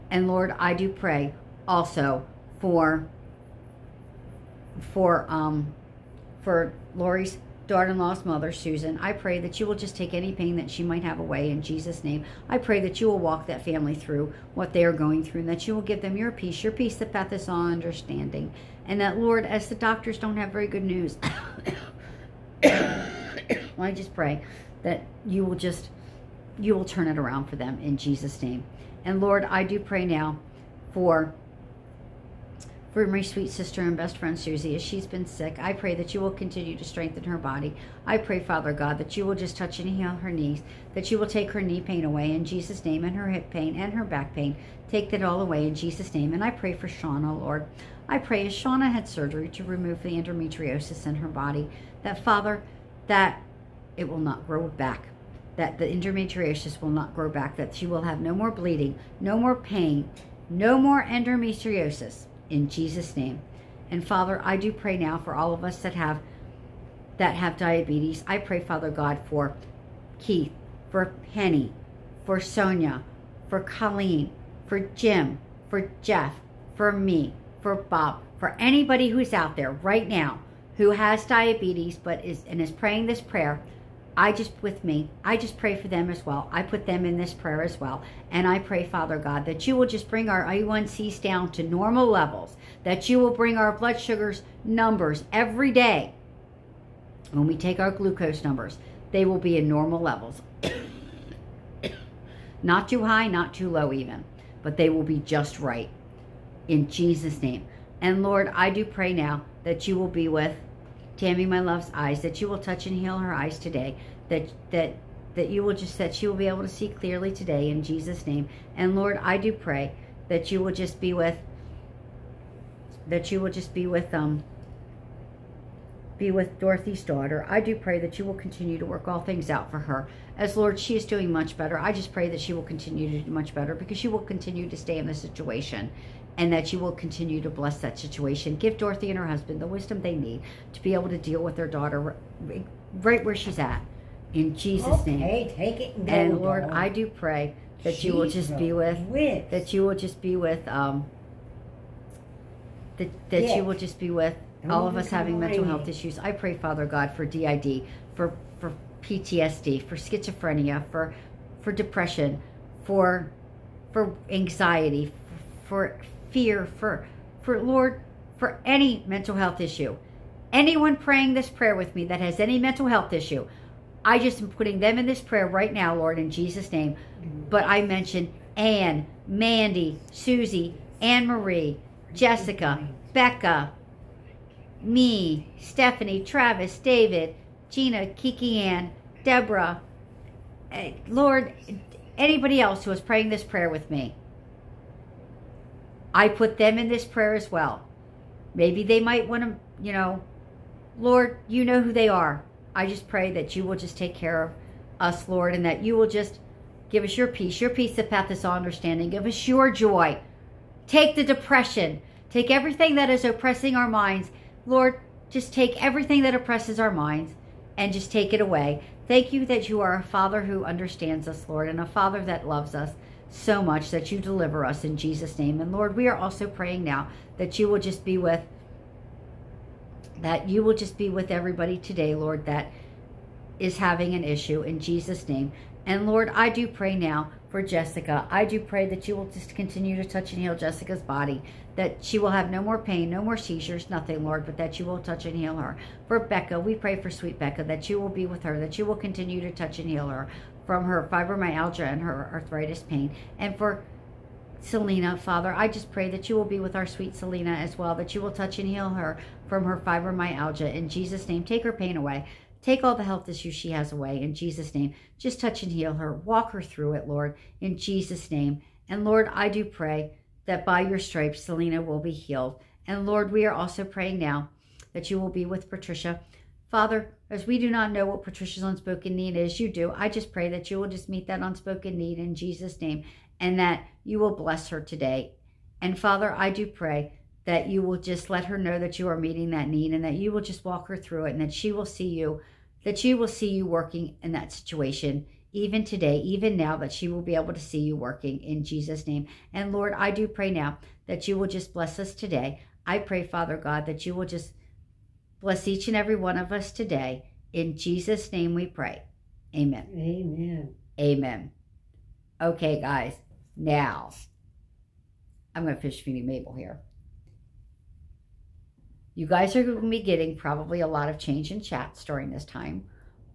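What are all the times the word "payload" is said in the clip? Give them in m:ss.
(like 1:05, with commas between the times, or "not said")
not said.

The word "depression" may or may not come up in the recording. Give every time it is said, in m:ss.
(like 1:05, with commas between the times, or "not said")
2:41, 3:31.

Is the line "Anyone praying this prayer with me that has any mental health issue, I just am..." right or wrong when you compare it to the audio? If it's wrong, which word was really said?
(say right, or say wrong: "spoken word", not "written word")
right.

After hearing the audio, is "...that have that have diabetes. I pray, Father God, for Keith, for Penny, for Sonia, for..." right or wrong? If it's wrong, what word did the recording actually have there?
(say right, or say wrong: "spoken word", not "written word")
right.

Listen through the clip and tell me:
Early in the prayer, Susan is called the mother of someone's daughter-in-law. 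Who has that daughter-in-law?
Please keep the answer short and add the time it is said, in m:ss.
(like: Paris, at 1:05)
Lori, at 0:06.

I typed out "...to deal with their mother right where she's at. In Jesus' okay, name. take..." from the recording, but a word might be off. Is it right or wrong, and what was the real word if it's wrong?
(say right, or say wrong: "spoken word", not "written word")
wrong: "daughter", not "mother".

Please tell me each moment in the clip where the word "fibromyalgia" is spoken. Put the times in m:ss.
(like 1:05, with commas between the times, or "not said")
4:11, 4:19.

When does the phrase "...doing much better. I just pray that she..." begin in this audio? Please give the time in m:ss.
2:11.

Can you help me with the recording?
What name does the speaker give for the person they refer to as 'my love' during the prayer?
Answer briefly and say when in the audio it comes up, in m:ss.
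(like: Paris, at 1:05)
Tammy, at 1:51.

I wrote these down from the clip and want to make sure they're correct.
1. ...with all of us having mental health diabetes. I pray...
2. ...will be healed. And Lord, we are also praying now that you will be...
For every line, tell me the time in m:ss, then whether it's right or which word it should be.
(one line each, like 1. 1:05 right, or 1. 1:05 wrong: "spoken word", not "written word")
1. 2:34 wrong: "issues", not "diabetes"
2. 4:31 right.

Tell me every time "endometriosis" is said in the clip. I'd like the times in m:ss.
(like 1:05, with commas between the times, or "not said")
0:50, 0:55, 1:01.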